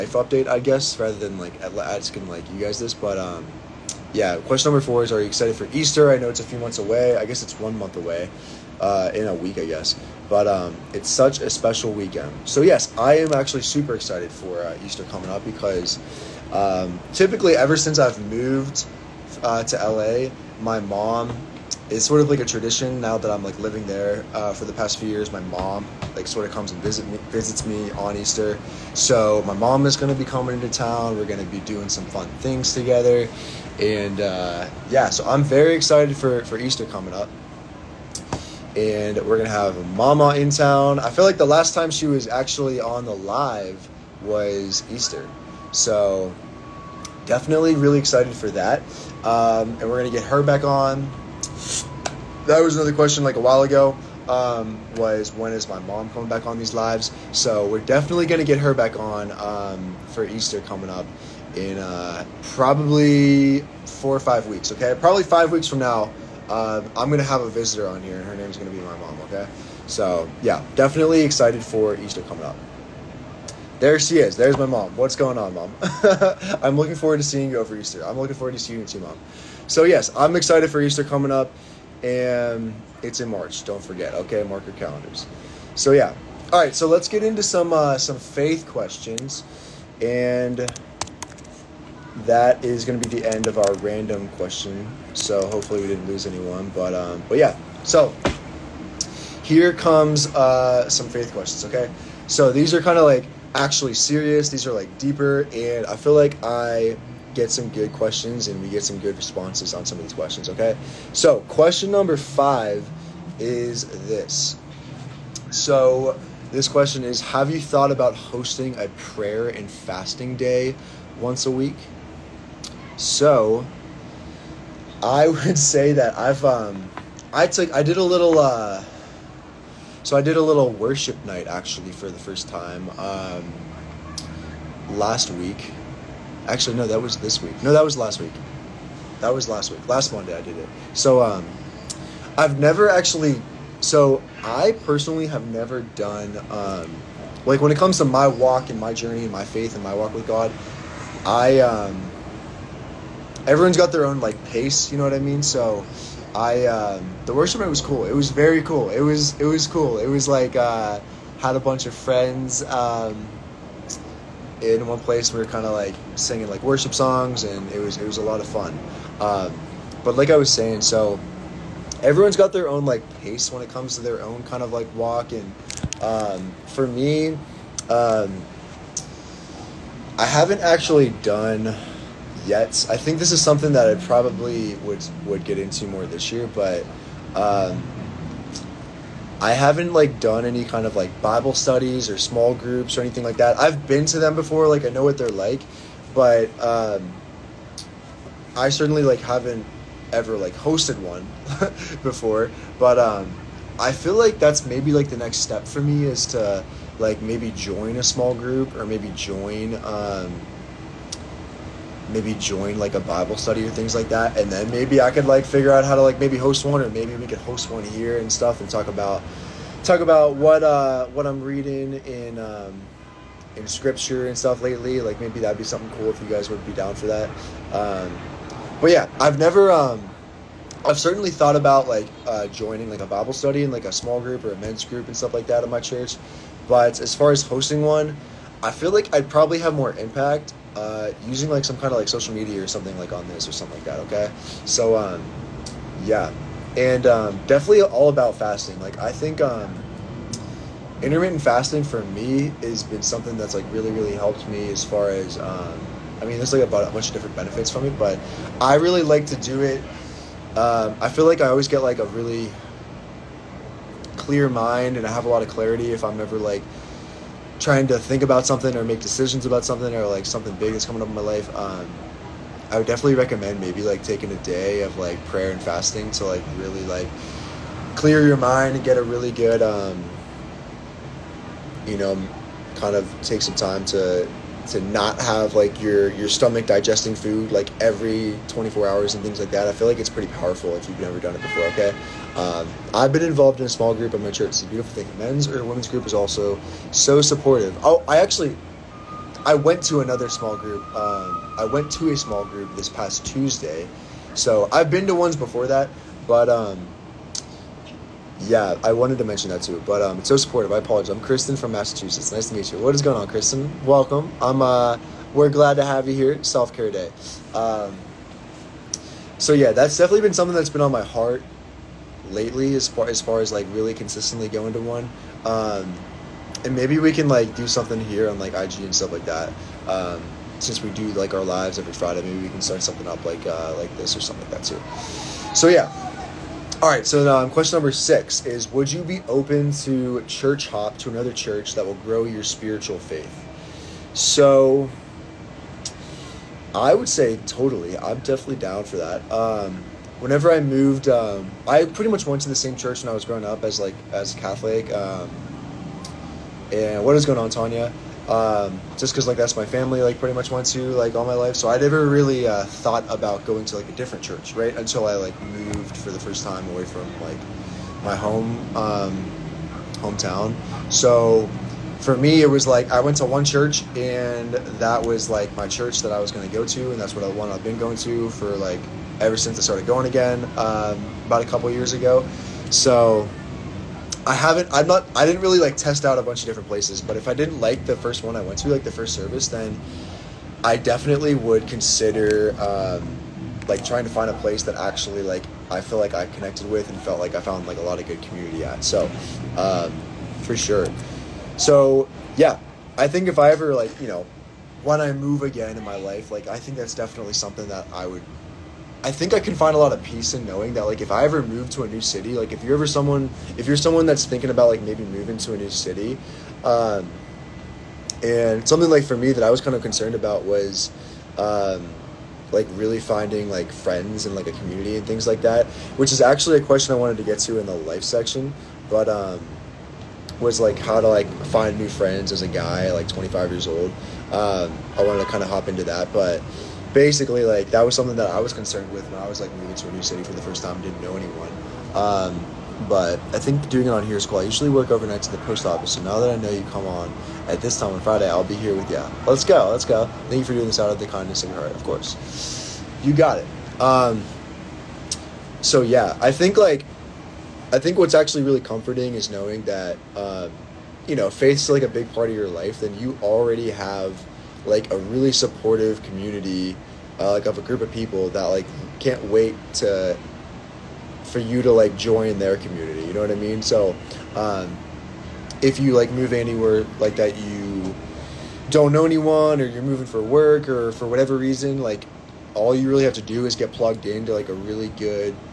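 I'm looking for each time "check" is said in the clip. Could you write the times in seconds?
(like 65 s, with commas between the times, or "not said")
not said.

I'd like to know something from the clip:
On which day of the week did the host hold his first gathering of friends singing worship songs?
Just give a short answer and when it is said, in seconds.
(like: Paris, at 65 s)
Monday, at 140 s.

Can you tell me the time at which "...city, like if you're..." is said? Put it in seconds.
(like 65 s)
412 s.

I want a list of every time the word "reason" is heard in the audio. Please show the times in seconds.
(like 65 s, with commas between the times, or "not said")
481 s.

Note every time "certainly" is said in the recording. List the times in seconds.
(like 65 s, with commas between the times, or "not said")
198 s, 230 s.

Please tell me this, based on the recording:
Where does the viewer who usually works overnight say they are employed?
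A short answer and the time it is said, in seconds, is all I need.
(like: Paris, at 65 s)
The post office, at 445 s.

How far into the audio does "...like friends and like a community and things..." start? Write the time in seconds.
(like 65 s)
423 s.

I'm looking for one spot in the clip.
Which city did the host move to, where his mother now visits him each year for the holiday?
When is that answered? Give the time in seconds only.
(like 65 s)
19 s.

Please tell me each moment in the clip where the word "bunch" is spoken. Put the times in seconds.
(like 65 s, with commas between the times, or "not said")
161 s, 256 s, 386 s.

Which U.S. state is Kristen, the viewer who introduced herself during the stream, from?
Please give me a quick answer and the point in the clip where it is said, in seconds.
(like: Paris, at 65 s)
Massachusetts, at 311 s.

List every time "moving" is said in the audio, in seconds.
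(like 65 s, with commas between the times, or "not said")
415 s, 439 s, 479 s.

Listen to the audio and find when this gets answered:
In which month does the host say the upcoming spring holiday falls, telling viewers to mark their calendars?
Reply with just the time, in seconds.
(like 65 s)
83 s.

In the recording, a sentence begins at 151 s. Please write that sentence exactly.
I um, everyone's got their own like pace.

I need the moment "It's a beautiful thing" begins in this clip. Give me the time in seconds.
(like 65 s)
294 s.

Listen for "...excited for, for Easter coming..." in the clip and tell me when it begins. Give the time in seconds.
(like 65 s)
35 s.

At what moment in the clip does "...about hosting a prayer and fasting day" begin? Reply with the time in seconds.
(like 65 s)
117 s.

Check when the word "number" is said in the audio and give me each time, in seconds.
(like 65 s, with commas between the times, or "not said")
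4 s, 111 s, 337 s.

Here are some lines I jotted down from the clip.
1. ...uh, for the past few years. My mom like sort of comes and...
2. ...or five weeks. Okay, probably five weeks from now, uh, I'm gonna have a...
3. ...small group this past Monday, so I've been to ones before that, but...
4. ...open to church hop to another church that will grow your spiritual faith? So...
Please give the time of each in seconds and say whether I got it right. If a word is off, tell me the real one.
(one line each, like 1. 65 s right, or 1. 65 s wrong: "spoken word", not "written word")
1. 24 s right
2. 64 s right
3. 302 s wrong: "Tuesday", not "Monday"
4. 339 s right.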